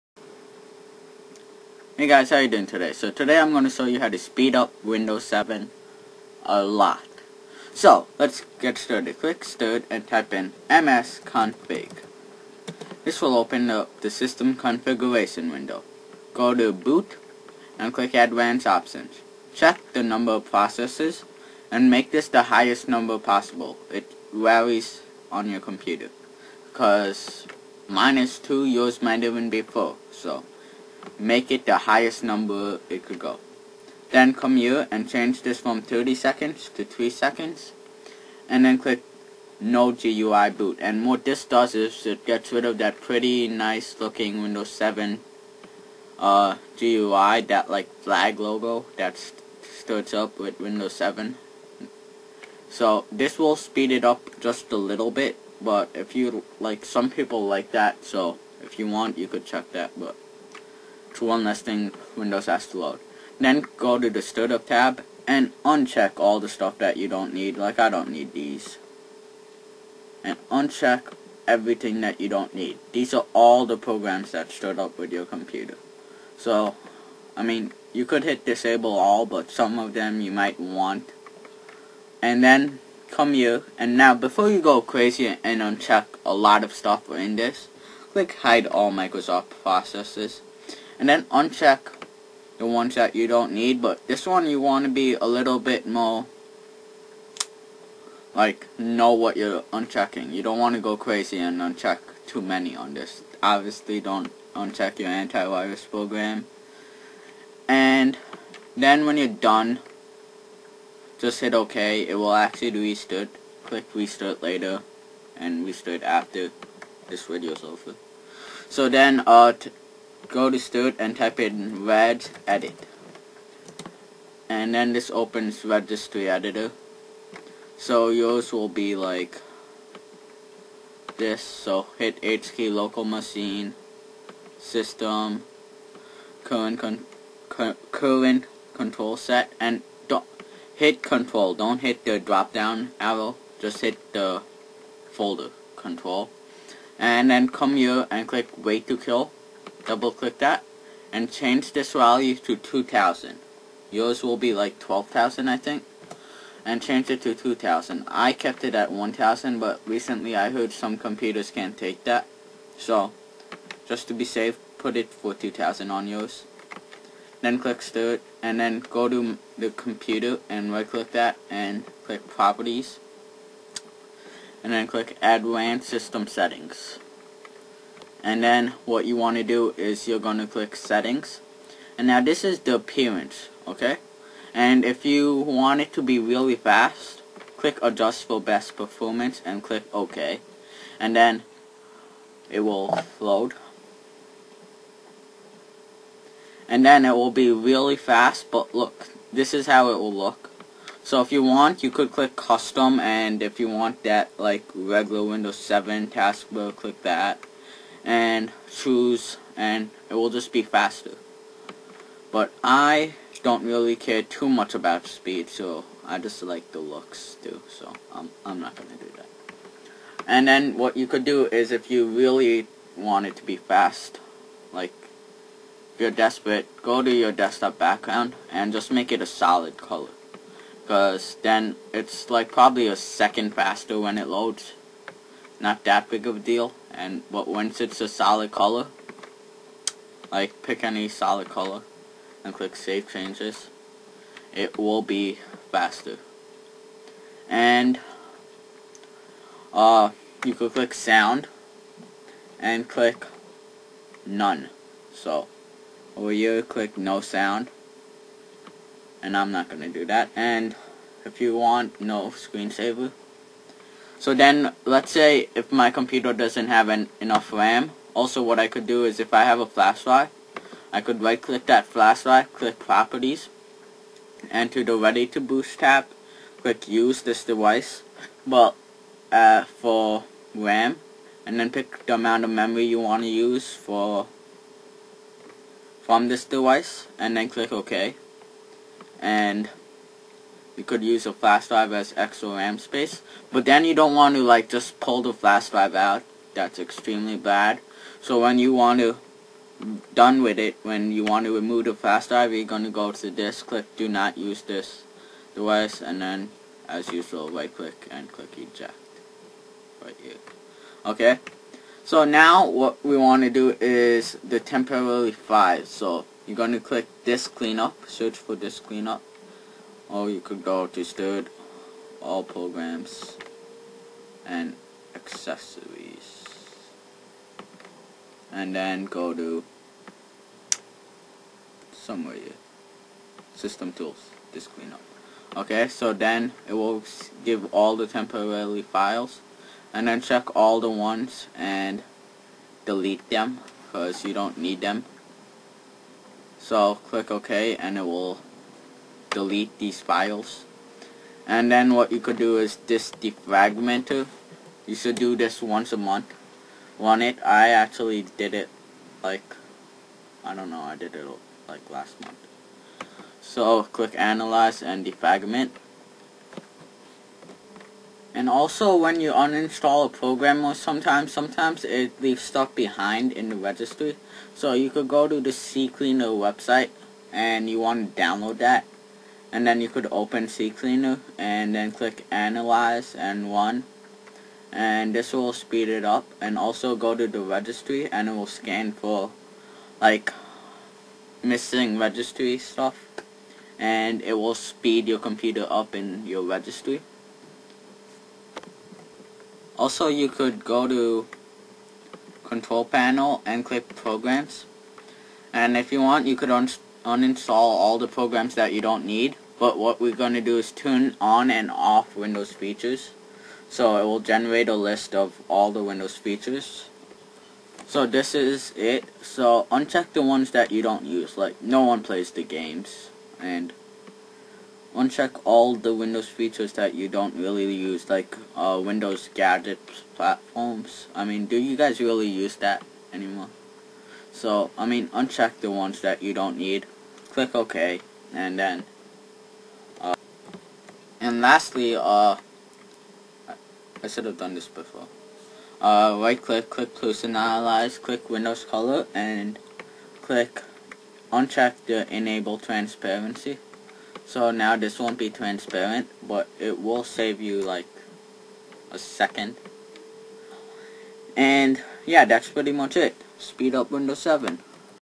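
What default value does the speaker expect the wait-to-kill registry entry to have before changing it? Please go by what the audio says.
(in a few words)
12,000.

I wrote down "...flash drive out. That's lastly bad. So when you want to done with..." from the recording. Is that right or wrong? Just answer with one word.
wrong.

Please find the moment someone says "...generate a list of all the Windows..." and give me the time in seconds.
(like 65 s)
414 s.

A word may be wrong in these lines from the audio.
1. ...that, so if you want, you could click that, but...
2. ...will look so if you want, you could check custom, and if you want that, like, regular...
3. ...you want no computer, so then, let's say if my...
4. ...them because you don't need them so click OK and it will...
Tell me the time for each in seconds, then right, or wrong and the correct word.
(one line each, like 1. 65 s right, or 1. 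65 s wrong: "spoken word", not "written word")
1. 57 s wrong: "check", not "click"
2. 199 s wrong: "click", not "check"
3. 261 s wrong: "screensaver", not "computer"
4. 343 s right.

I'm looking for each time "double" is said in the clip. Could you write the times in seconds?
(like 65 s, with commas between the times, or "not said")
149 s.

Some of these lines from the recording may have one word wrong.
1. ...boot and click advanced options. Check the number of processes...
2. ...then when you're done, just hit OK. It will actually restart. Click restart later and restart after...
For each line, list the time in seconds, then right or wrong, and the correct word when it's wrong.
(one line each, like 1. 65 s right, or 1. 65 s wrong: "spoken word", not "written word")
1. 16 s right
2. 108 s right.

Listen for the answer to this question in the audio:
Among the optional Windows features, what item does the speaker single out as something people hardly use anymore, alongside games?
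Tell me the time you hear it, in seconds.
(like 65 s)
428 s.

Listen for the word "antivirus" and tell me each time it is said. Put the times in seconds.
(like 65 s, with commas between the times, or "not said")
105 s.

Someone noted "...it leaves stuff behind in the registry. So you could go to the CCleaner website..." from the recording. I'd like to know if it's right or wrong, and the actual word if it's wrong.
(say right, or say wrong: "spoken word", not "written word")
right.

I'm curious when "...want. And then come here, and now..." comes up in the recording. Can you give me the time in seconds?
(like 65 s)
80 s.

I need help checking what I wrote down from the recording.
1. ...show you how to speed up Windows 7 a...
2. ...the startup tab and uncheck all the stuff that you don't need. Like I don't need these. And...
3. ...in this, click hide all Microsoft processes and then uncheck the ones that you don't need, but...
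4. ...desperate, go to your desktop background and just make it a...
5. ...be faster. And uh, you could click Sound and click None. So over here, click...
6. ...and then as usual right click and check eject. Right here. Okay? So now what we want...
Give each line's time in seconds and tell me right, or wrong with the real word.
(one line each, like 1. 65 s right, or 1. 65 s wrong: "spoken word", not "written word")
1. 3 s right
2. 64 s right
3. 87 s right
4. 226 s right
5. 245 s right
6. 306 s wrong: "click", not "check".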